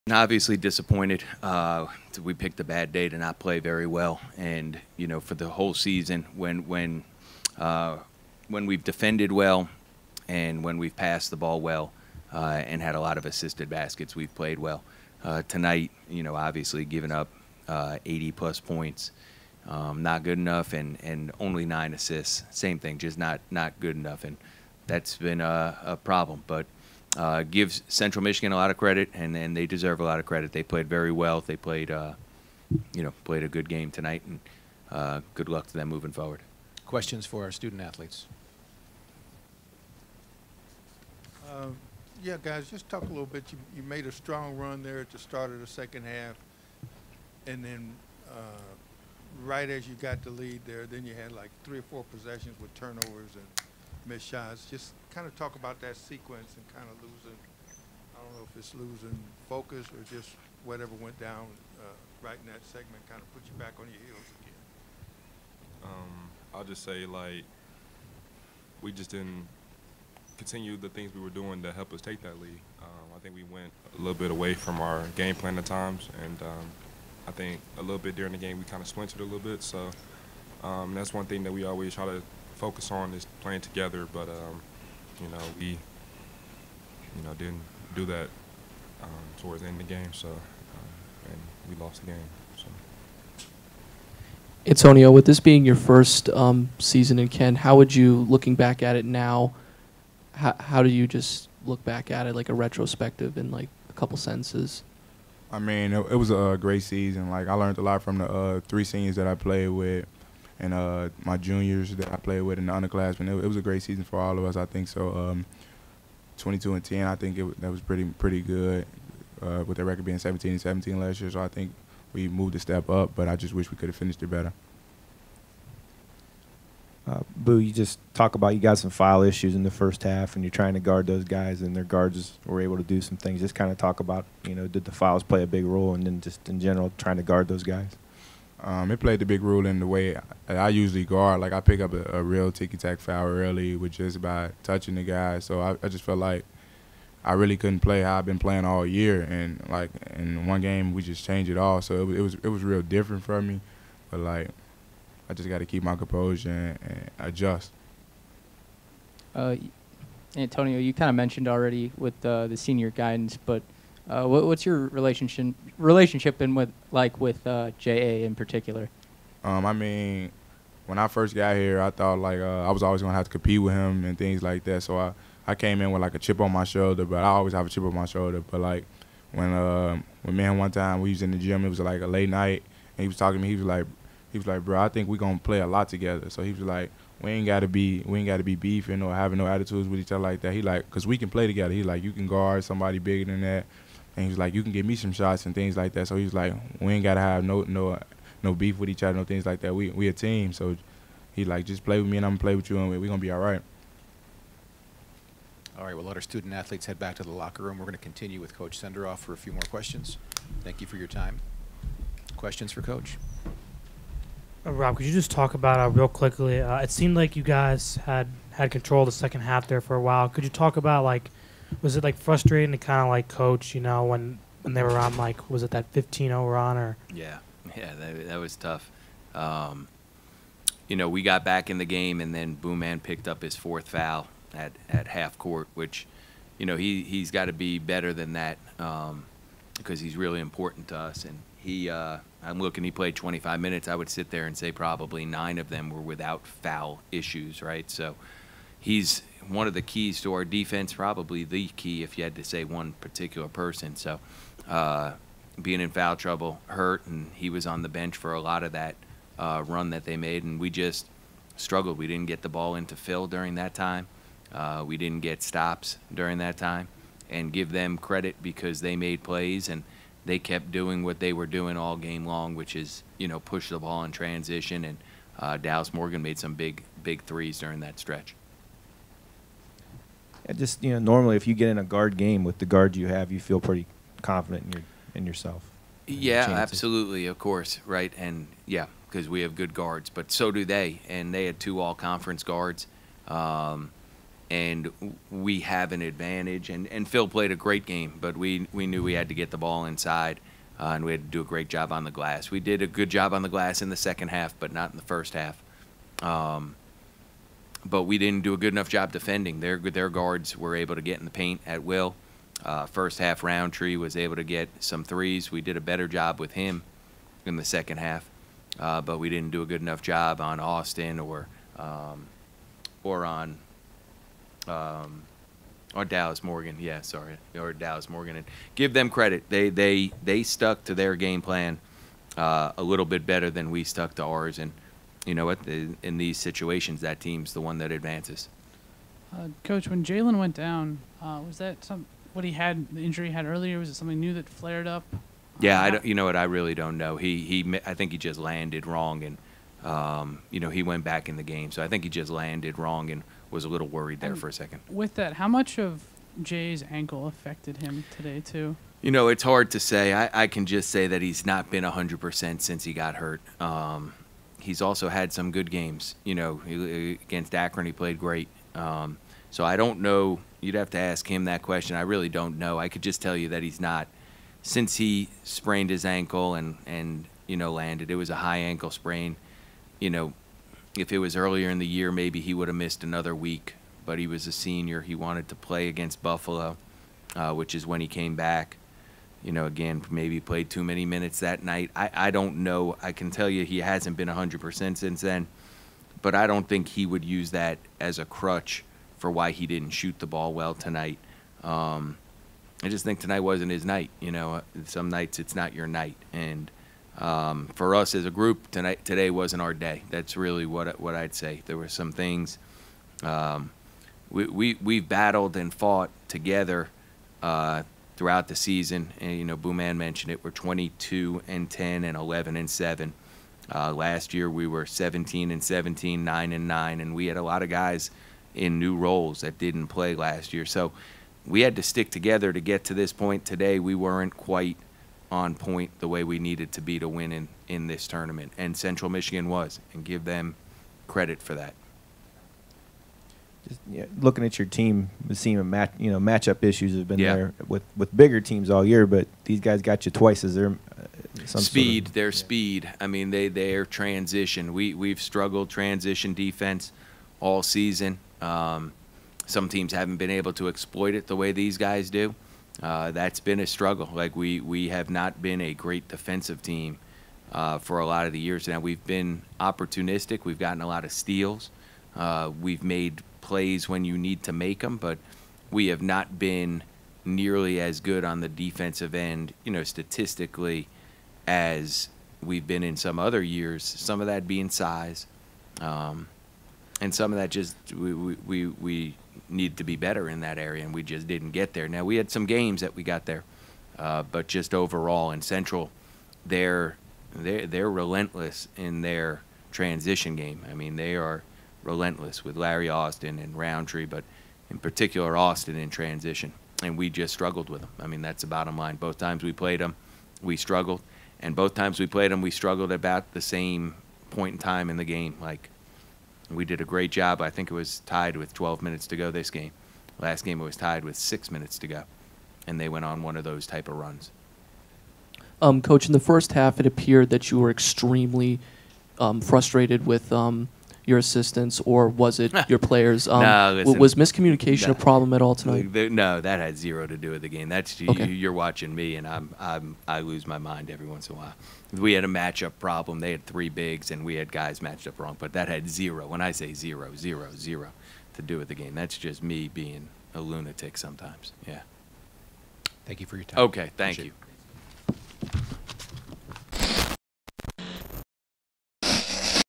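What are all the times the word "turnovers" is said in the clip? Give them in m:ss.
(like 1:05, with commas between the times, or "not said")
0:52.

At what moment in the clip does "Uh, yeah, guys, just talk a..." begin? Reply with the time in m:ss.
0:41.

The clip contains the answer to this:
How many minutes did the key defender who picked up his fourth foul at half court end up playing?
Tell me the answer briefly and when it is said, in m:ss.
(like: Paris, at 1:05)
25, at 4:03.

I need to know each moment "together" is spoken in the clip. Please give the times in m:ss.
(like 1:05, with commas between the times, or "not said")
1:23, 3:05, 3:11, 6:56, 7:12.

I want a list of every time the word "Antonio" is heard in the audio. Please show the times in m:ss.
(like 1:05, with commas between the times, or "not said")
1:34, 2:40.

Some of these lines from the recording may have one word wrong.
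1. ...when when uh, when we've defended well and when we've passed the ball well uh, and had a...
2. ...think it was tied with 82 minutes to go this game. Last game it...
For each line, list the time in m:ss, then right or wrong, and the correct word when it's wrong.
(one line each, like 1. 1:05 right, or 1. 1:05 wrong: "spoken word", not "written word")
1. 0:06 right
2. 8:37 wrong: "12", not "82".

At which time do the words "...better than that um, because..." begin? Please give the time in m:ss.
3:57.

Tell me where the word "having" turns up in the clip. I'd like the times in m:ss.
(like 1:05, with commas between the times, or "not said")
3:09.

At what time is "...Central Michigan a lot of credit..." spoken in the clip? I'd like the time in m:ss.
0:27.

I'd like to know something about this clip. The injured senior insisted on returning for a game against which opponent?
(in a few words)
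Buffalo.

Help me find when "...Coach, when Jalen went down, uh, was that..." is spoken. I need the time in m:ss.
5:39.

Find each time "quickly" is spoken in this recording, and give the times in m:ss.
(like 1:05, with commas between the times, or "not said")
3:36.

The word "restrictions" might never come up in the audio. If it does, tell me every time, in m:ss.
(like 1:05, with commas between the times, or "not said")
not said.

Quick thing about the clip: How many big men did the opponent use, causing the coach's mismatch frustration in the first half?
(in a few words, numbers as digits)
3.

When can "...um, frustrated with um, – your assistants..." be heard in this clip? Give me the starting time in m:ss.
8:49.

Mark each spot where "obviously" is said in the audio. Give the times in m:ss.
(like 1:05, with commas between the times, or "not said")
0:00, 0:16.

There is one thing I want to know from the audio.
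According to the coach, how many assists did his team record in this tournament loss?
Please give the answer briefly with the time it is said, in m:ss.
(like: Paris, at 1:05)
9, at 0:21.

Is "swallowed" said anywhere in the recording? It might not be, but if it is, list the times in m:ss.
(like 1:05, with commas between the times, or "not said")
not said.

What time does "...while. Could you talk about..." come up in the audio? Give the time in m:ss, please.
3:40.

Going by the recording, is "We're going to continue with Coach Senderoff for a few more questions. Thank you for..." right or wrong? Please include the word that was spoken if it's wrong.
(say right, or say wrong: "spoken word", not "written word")
right.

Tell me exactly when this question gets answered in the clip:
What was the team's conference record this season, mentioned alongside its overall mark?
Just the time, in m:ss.
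7:02.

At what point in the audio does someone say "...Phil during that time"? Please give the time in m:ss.
4:22.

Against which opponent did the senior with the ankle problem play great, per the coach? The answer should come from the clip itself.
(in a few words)
Akron.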